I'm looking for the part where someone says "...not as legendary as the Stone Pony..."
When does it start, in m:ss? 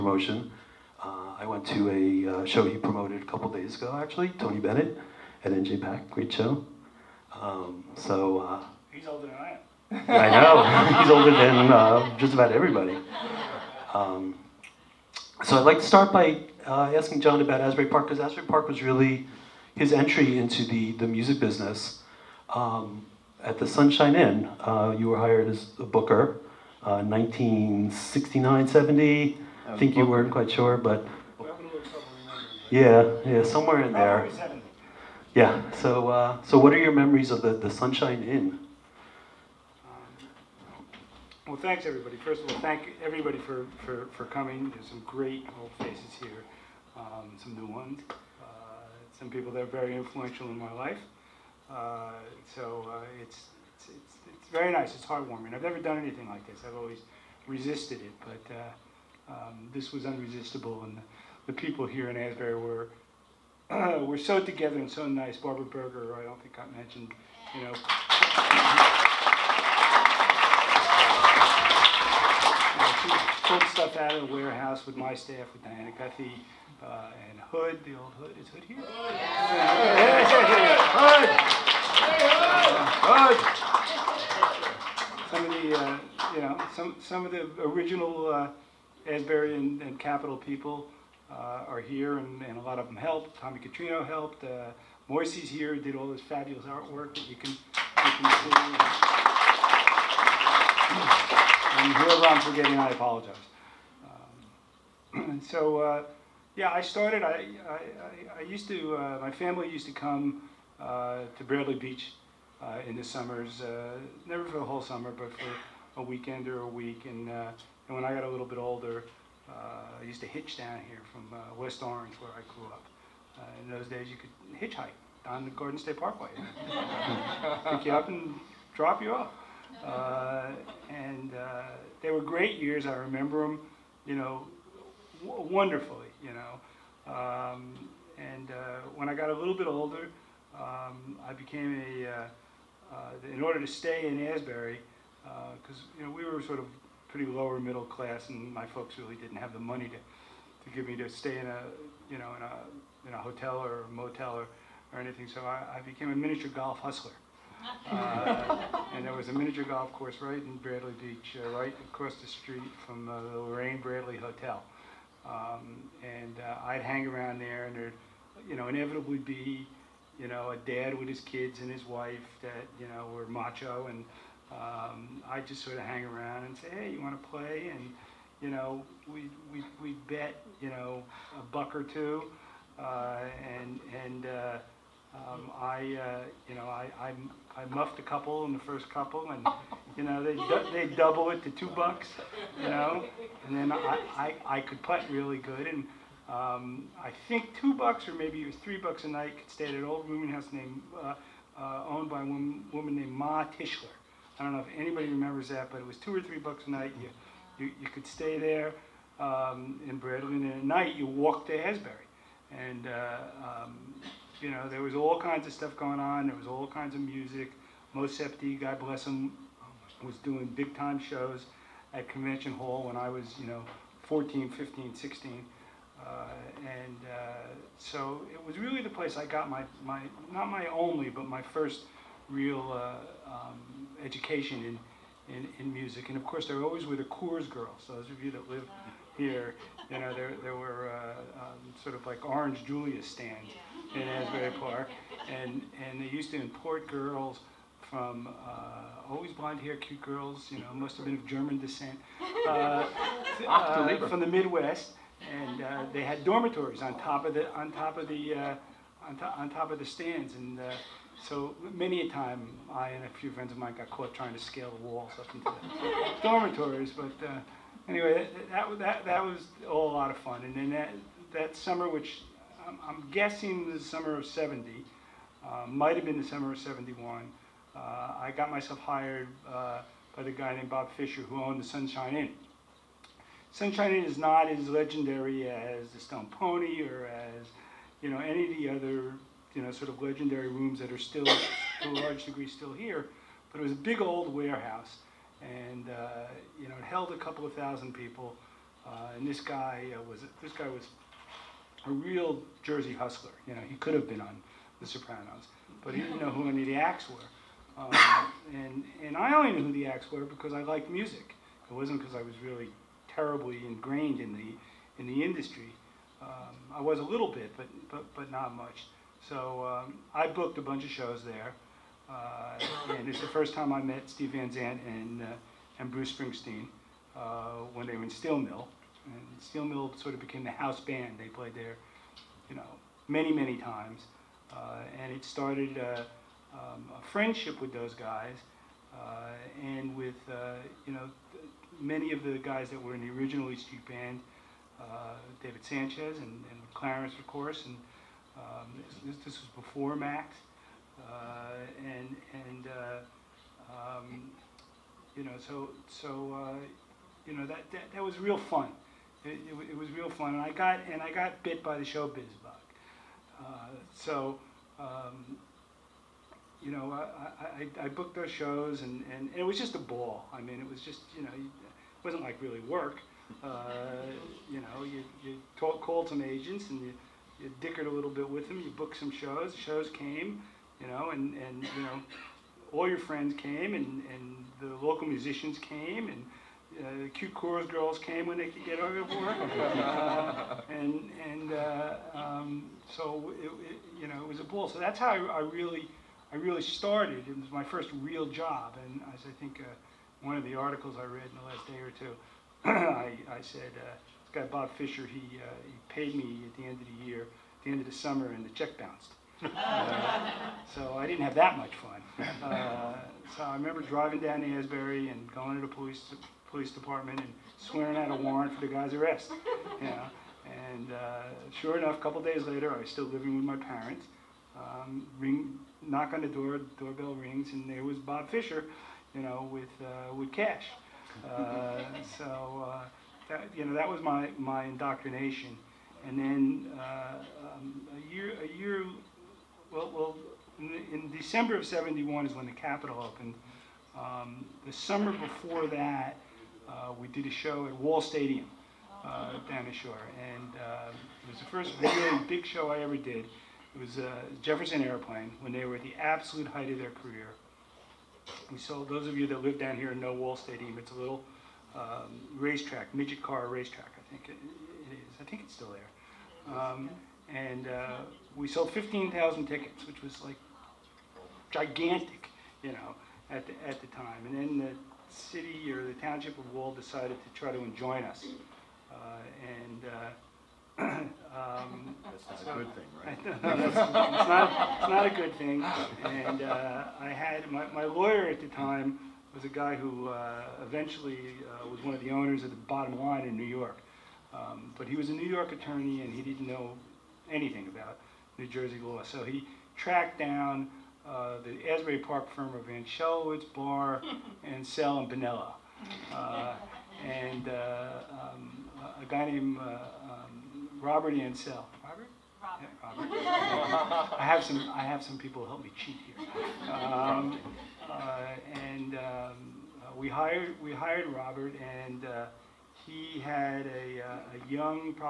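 4:44.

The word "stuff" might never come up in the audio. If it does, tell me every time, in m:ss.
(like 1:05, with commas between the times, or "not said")
1:13, 3:35.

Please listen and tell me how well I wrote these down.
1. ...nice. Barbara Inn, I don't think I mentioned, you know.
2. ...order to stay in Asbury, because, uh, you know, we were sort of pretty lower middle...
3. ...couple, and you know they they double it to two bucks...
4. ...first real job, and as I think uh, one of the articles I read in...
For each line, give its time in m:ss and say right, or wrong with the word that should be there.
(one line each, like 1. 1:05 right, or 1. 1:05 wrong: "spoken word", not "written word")
1. 1:05 wrong: "Berger", not "Inn"
2. 2:23 right
3. 3:08 right
4. 6:37 right.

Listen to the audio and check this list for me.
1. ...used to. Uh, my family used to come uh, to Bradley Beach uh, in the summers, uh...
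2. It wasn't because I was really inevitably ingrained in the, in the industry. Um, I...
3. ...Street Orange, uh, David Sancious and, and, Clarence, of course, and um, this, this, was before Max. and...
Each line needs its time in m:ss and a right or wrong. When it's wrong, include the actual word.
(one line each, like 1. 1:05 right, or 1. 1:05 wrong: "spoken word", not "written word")
1. 1:48 right
2. 5:11 wrong: "terribly", not "inevitably"
3. 5:43 wrong: "Band", not "Orange".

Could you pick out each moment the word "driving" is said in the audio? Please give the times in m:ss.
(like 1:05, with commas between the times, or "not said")
6:53.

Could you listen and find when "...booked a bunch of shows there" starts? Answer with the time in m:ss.
5:20.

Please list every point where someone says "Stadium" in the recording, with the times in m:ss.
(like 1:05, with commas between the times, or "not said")
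7:27, 7:40.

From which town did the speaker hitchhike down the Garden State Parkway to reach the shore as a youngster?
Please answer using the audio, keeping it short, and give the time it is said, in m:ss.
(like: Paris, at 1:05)
West Orange, at 2:01.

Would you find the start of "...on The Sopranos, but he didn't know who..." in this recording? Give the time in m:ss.
5:04.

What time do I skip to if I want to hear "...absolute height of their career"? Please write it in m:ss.
7:35.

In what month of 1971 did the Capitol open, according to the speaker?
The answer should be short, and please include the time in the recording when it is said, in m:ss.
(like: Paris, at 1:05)
December, at 7:21.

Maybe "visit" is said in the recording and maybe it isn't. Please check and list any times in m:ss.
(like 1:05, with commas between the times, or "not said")
not said.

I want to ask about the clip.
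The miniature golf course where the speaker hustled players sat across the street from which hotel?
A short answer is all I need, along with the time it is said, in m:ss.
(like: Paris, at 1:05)
Lorraine Bradley Hotel, at 2:43.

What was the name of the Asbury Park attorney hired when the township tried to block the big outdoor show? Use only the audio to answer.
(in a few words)
Robert Ansell.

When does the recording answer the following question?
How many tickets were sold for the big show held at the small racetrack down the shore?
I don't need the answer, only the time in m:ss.
7:48.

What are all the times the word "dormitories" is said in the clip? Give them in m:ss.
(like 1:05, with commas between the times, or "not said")
4:16, 4:26.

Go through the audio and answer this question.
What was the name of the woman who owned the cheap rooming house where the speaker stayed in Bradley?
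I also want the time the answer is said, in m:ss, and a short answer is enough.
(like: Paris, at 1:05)
Ma Tischler, at 3:23.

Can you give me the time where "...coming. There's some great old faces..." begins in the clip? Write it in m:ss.
0:44.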